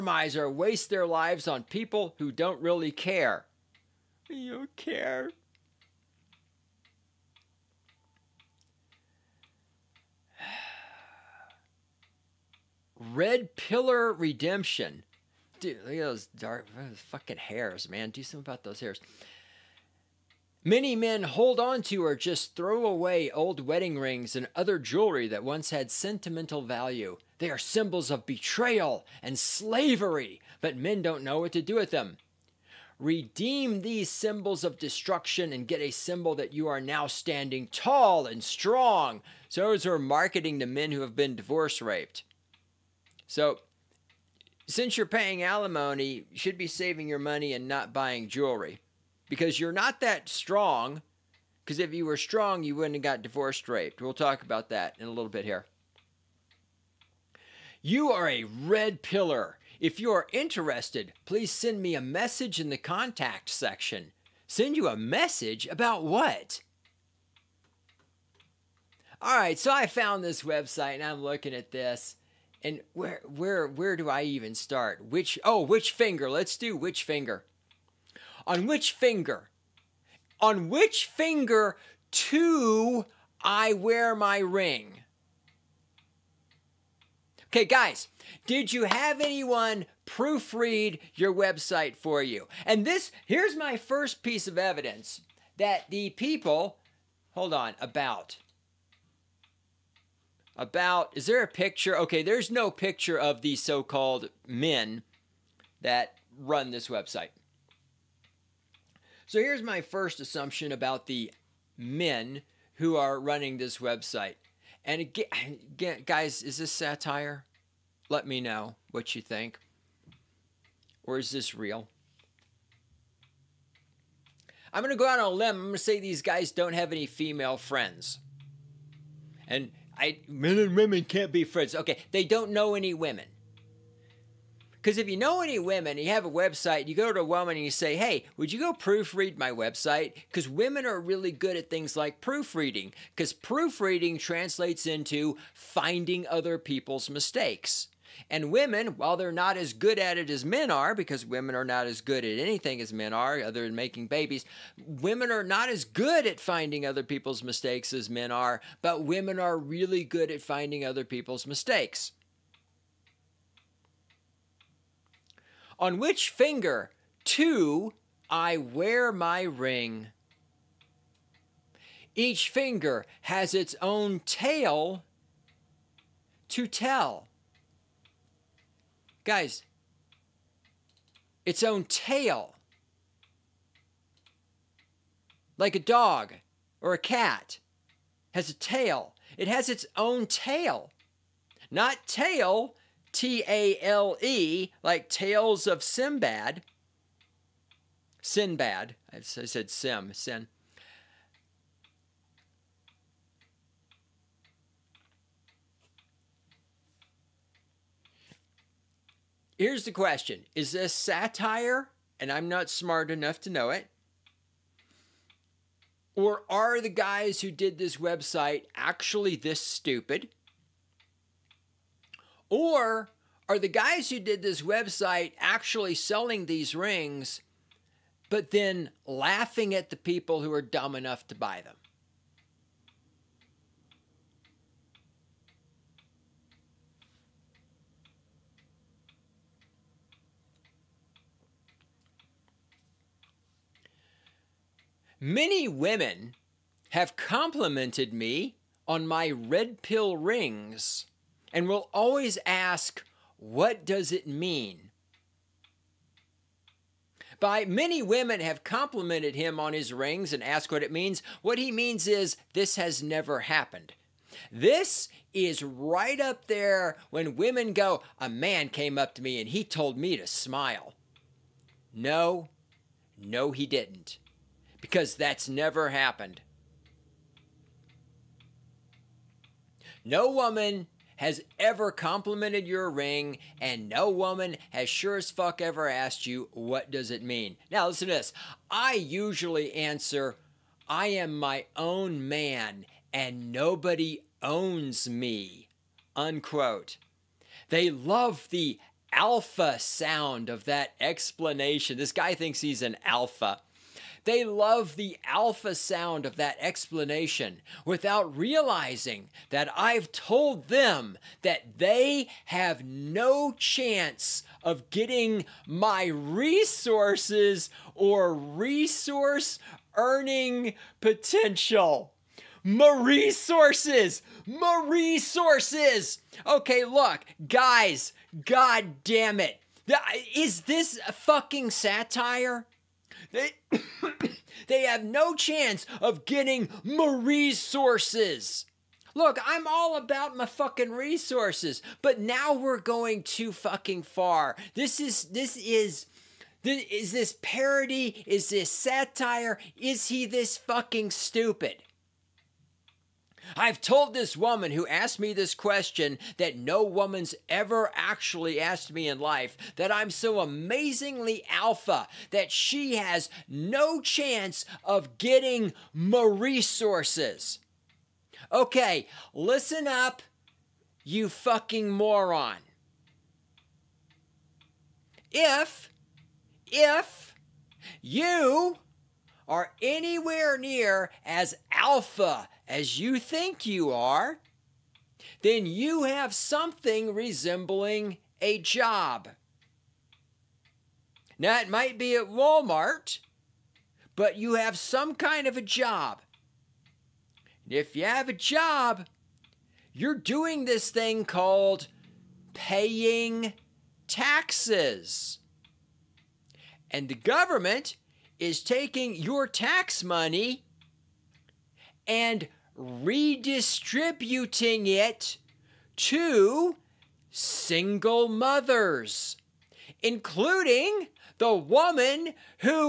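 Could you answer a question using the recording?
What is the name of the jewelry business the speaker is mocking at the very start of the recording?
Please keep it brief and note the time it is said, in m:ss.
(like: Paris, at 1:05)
Red Pillar Redemption, at 0:13.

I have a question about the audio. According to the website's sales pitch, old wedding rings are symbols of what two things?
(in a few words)
Betrayal and slavery.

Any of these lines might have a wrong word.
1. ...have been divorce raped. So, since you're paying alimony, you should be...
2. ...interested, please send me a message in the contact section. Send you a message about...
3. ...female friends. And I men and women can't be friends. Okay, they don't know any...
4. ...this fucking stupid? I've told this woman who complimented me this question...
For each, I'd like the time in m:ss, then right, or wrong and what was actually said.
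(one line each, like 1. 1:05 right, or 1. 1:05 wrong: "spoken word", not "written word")
1. 0:41 right
2. 1:00 right
3. 2:07 right
4. 5:50 wrong: "asked", not "complimented".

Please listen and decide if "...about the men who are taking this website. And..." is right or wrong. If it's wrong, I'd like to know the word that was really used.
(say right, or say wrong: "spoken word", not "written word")
wrong: "running", not "taking".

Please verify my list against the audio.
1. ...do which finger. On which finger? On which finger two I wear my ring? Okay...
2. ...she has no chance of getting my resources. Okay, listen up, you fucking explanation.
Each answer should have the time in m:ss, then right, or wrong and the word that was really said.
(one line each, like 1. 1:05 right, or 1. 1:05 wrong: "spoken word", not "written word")
1. 1:16 right
2. 6:02 wrong: "moron", not "explanation".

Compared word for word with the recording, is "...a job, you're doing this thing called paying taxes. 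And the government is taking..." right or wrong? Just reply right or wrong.
right.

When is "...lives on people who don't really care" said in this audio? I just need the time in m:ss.
0:01.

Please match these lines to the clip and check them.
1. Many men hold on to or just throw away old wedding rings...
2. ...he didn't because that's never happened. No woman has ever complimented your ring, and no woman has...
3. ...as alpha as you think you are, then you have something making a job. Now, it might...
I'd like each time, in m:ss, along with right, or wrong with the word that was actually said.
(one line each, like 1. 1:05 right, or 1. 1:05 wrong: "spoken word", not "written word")
1. 0:20 right
2. 4:33 right
3. 6:21 wrong: "resembling", not "making".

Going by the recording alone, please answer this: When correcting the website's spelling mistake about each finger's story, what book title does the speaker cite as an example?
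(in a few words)
Tales of Sinbad.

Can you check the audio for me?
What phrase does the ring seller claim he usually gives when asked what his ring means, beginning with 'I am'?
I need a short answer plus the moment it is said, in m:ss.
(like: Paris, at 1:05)
I am my own man, at 4:50.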